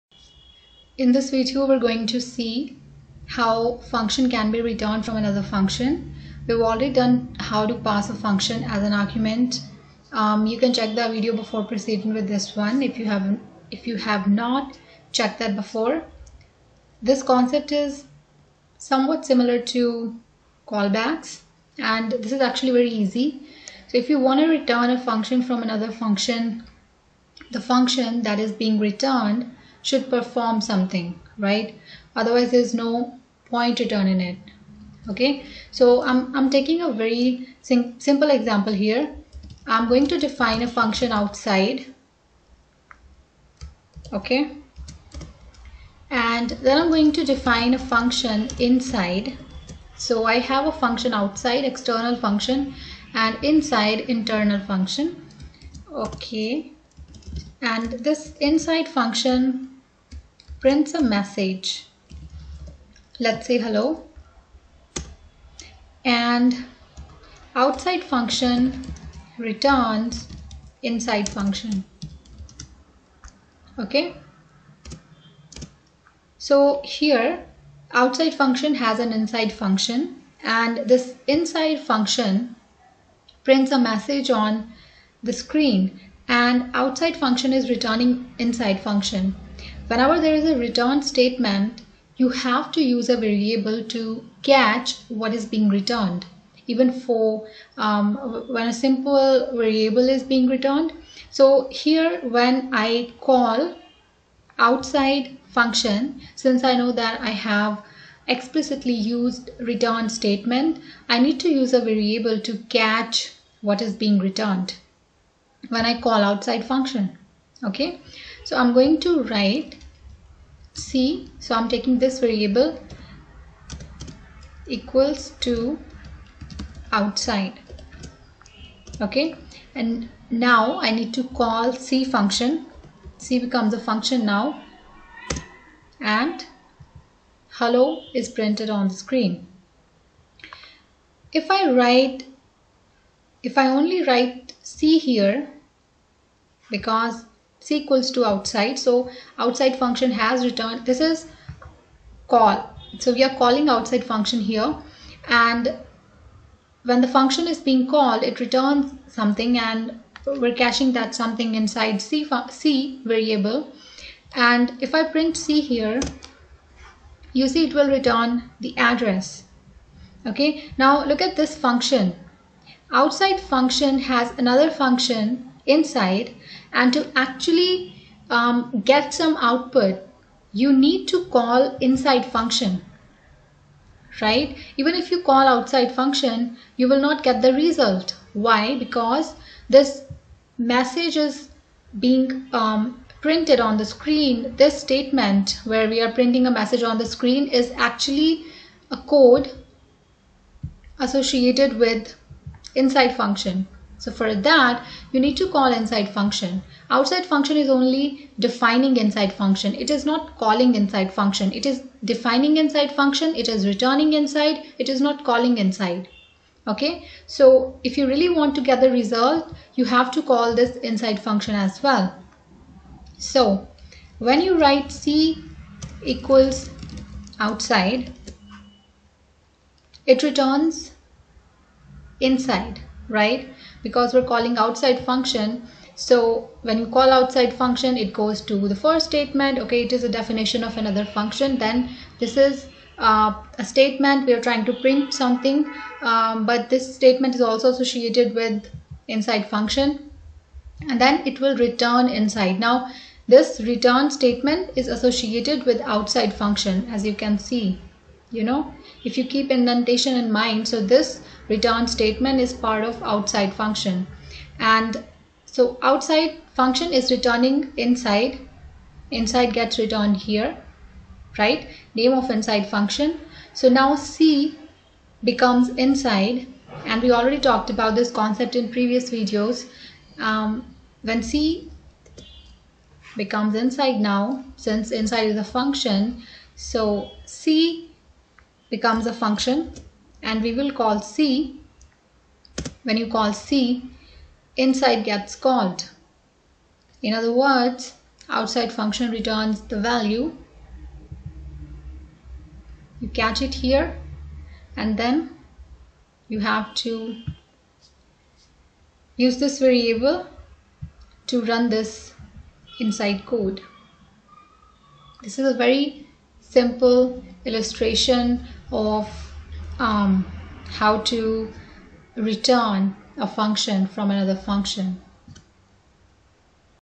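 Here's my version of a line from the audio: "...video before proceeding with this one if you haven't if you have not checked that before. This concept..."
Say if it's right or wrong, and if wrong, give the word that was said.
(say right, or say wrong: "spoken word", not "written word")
right.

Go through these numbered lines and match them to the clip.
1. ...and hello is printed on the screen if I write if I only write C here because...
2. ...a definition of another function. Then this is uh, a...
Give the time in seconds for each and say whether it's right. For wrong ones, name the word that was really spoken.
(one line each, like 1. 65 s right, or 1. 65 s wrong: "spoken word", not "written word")
1. 135 s right
2. 240 s right.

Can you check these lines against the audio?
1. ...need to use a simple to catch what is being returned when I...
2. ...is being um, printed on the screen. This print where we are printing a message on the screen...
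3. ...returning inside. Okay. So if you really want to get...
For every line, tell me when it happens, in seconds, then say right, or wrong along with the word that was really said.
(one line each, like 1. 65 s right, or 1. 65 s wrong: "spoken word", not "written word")
1. 111 s wrong: "variable", not "simple"
2. 191 s wrong: "statement", not "print"
3. 215 s wrong: "calling", not "returning".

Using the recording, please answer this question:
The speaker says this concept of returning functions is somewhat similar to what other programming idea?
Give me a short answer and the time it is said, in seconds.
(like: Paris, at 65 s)
callbacks, at 20 s.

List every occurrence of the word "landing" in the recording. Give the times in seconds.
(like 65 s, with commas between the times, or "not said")
not said.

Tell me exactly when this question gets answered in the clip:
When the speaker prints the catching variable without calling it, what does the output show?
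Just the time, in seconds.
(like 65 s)
167 s.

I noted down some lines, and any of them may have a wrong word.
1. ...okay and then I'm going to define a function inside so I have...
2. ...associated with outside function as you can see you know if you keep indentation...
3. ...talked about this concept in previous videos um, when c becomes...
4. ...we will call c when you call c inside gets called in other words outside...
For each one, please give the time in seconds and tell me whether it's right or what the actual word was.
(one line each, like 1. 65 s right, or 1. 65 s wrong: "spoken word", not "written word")
1. 44 s right
2. 254 s right
3. 277 s right
4. 290 s right.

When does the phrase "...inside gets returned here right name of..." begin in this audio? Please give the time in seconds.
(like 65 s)
269 s.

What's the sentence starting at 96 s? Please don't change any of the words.
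Even for um, when a simple variable is being returned.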